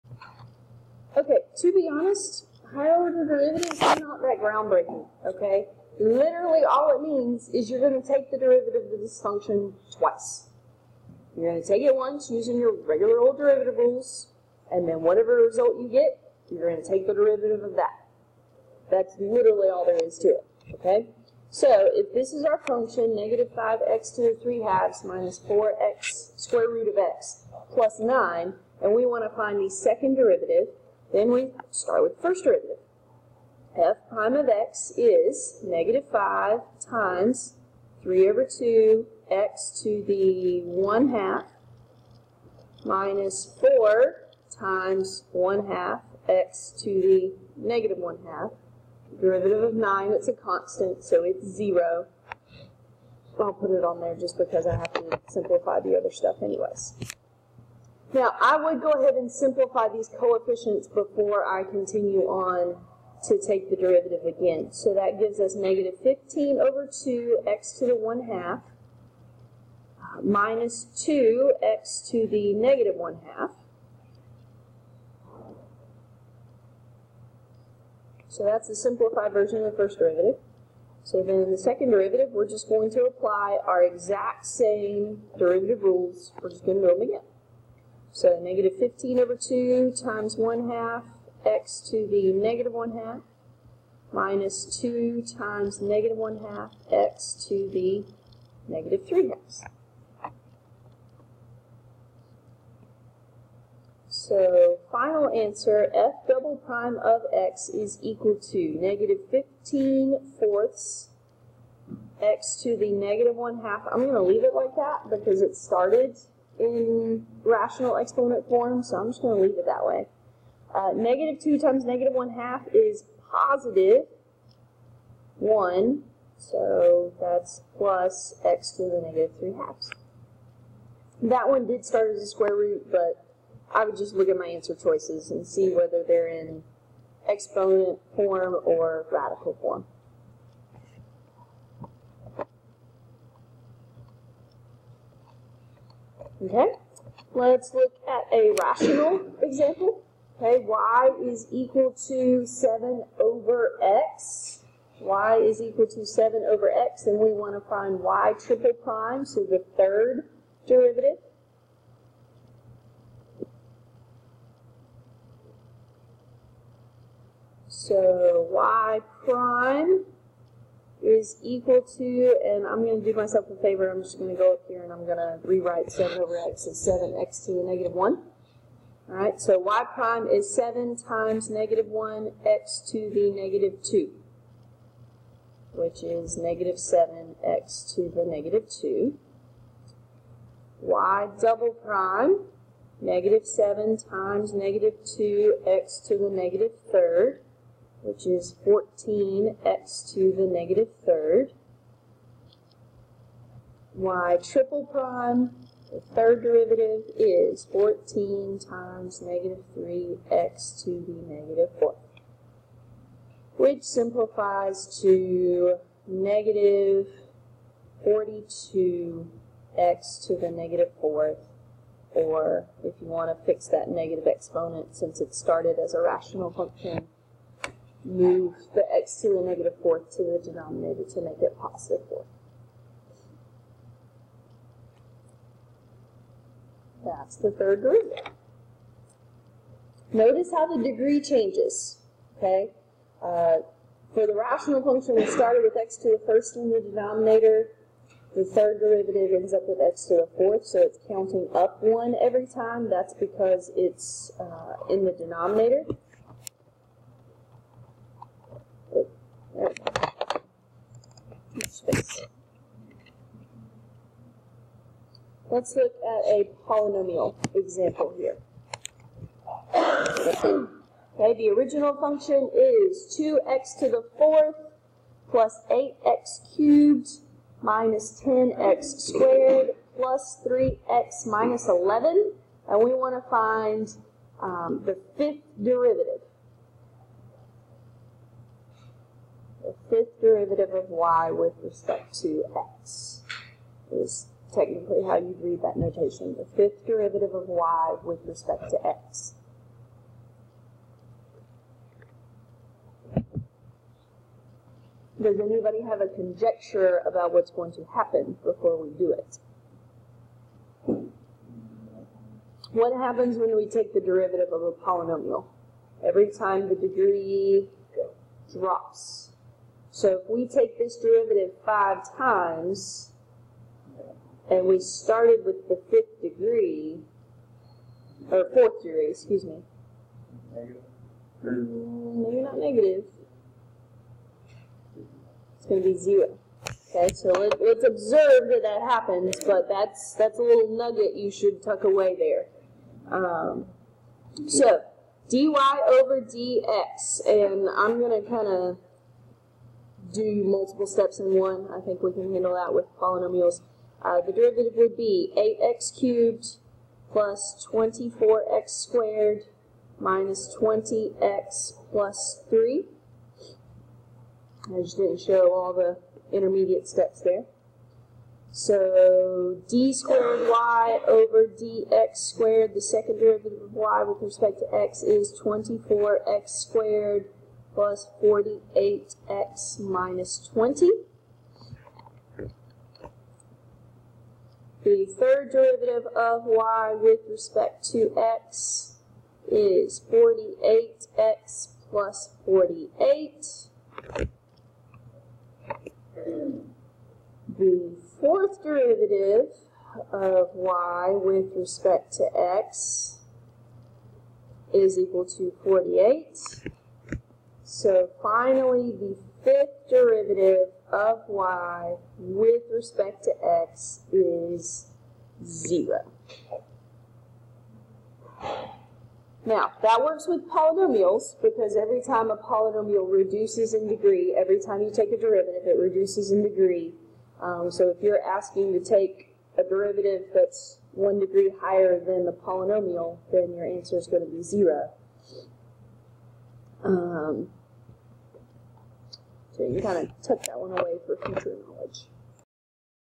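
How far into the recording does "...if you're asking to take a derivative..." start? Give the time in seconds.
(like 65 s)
427 s.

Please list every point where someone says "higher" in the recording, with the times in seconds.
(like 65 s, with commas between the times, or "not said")
2 s, 431 s.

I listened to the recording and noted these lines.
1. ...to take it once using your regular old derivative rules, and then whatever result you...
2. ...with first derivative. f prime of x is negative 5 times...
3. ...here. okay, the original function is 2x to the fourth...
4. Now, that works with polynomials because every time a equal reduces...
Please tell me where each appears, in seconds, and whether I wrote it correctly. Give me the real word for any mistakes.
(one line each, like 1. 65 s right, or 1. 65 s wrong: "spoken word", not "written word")
1. 11 s right
2. 32 s right
3. 268 s right
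4. 419 s wrong: "polynomial", not "equal".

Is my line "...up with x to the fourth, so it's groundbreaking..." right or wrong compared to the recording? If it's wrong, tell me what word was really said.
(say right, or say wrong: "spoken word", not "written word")
wrong: "counting", not "groundbreaking".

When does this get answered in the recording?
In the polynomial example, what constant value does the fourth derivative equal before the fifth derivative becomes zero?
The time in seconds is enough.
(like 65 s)
404 s.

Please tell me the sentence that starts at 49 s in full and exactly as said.
Derivative of 9, it's a constant, so it's 0.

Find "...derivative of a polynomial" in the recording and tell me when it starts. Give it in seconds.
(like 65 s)
314 s.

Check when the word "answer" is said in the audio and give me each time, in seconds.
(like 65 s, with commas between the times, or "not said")
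105 s, 134 s, 433 s.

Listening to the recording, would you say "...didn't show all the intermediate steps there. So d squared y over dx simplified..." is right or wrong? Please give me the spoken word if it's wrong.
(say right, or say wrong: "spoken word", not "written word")
wrong: "squared", not "simplified".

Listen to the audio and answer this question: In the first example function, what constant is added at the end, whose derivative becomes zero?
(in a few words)
9.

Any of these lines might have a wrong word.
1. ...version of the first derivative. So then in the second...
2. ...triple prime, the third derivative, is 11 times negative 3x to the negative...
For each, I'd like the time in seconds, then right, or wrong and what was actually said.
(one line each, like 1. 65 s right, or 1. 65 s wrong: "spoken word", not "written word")
1. 79 s right
2. 204 s wrong: "14", not "11".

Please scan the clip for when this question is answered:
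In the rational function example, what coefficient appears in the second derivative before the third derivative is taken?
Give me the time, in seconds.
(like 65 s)
198 s.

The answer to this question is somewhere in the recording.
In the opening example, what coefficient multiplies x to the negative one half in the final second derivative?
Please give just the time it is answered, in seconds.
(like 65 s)
108 s.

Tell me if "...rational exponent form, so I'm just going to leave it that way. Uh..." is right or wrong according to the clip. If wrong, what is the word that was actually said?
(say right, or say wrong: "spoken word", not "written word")
right.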